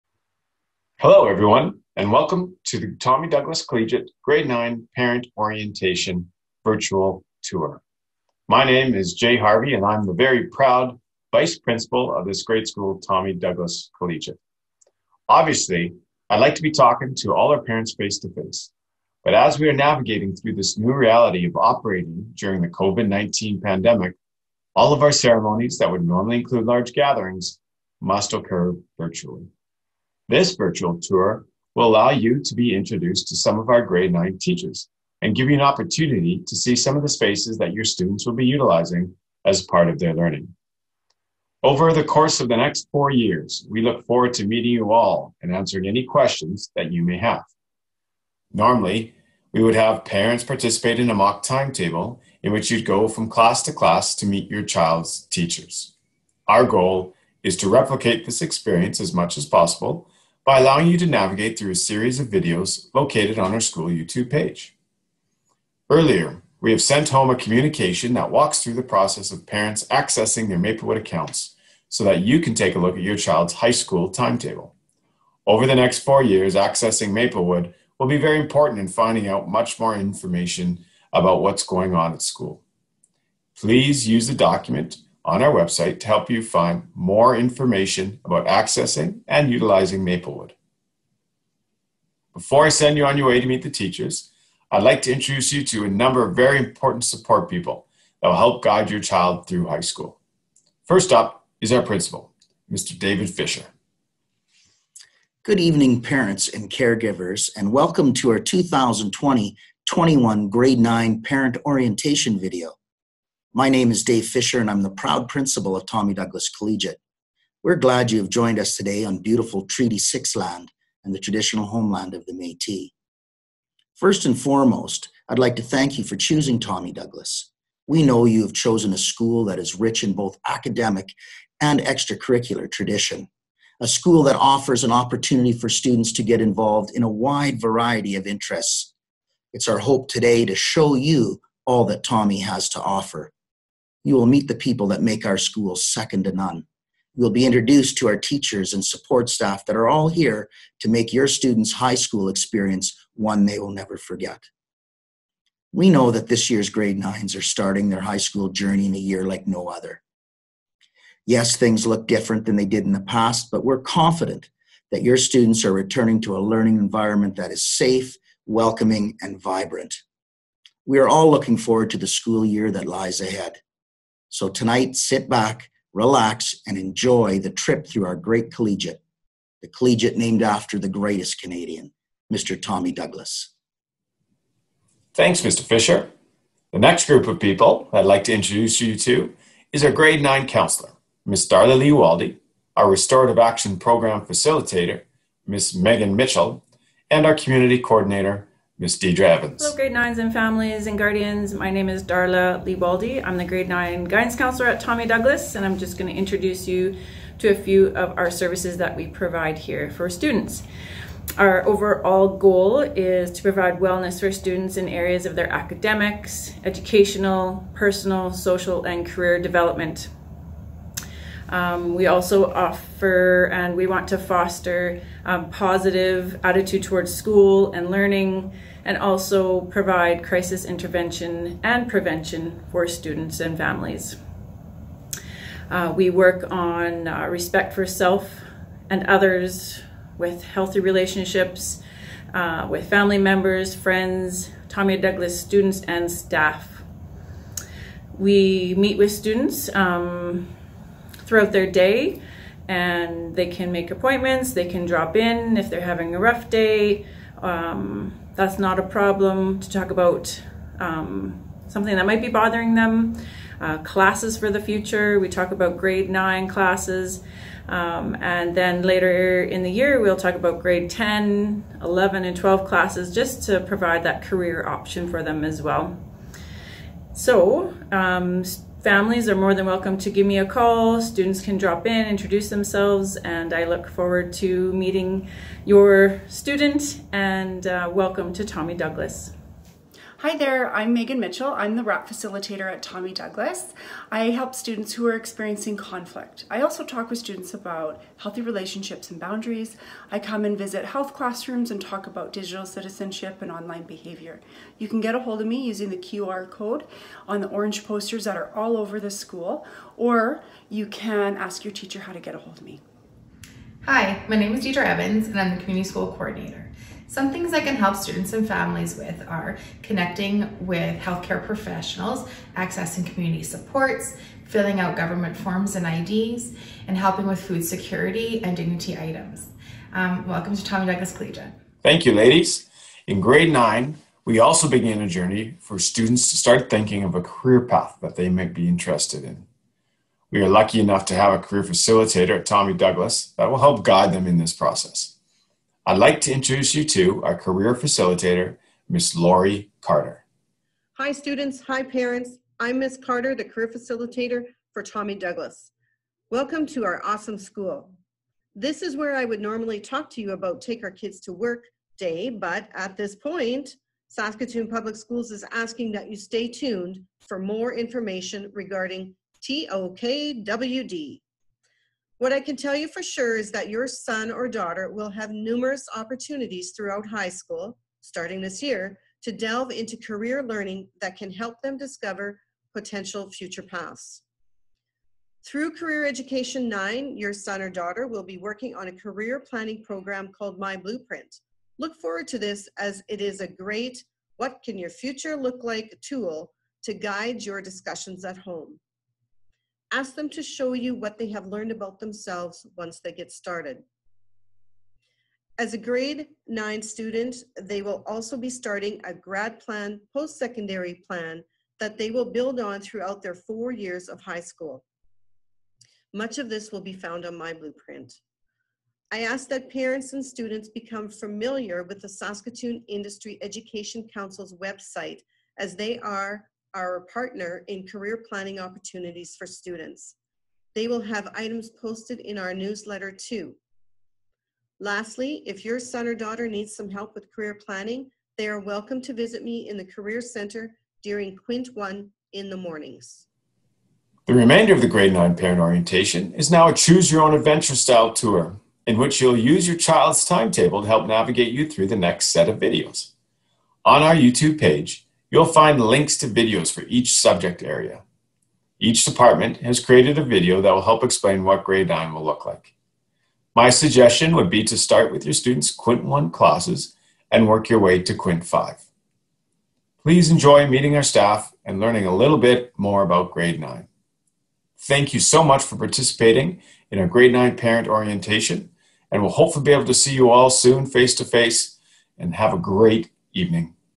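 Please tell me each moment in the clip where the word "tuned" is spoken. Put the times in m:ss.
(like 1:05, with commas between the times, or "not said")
6:06.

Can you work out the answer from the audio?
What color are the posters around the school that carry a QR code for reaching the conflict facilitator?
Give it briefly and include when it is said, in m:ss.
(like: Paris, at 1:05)
Orange, at 5:07.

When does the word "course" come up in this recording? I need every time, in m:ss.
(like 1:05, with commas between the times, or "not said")
0:42.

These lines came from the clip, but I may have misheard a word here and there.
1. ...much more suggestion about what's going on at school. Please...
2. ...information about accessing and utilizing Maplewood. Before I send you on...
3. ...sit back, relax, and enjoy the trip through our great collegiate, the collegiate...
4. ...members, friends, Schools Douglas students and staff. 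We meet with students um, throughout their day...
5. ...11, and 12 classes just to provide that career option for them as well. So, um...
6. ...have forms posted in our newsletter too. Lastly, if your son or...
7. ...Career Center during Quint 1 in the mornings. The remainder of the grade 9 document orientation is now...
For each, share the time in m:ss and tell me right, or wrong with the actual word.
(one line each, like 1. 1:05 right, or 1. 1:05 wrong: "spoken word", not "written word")
1. 1:19 wrong: "information", not "suggestion"
2. 1:27 right
3. 2:54 right
4. 4:03 wrong: "Tommy", not "Schools"
5. 4:31 right
6. 7:11 wrong: "items", not "forms"
7. 7:19 wrong: "parent", not "document".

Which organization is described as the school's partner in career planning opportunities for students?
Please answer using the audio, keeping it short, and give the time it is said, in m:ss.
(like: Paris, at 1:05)
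Saskatoon Industry Education Council, at 7:02.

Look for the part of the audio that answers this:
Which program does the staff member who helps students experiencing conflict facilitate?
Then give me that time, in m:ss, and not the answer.
3:12.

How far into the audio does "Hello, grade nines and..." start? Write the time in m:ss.
3:19.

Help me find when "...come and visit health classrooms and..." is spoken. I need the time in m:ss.
5:00.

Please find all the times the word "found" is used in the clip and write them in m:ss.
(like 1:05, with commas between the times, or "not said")
6:56.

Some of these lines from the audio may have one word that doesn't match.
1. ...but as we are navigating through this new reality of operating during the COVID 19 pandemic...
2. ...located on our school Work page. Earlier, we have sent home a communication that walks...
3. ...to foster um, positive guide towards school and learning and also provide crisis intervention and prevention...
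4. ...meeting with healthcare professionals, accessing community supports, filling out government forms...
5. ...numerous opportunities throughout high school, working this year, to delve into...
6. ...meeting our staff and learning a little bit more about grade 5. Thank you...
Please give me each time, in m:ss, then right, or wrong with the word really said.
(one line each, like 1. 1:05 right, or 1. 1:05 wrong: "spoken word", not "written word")
1. 0:19 right
2. 1:02 wrong: "YouTube", not "Work"
3. 3:44 wrong: "attitude", not "guide"
4. 5:19 wrong: "connecting", not "meeting"
5. 6:15 wrong: "starting", not "working"
6. 7:50 wrong: "9", not "5".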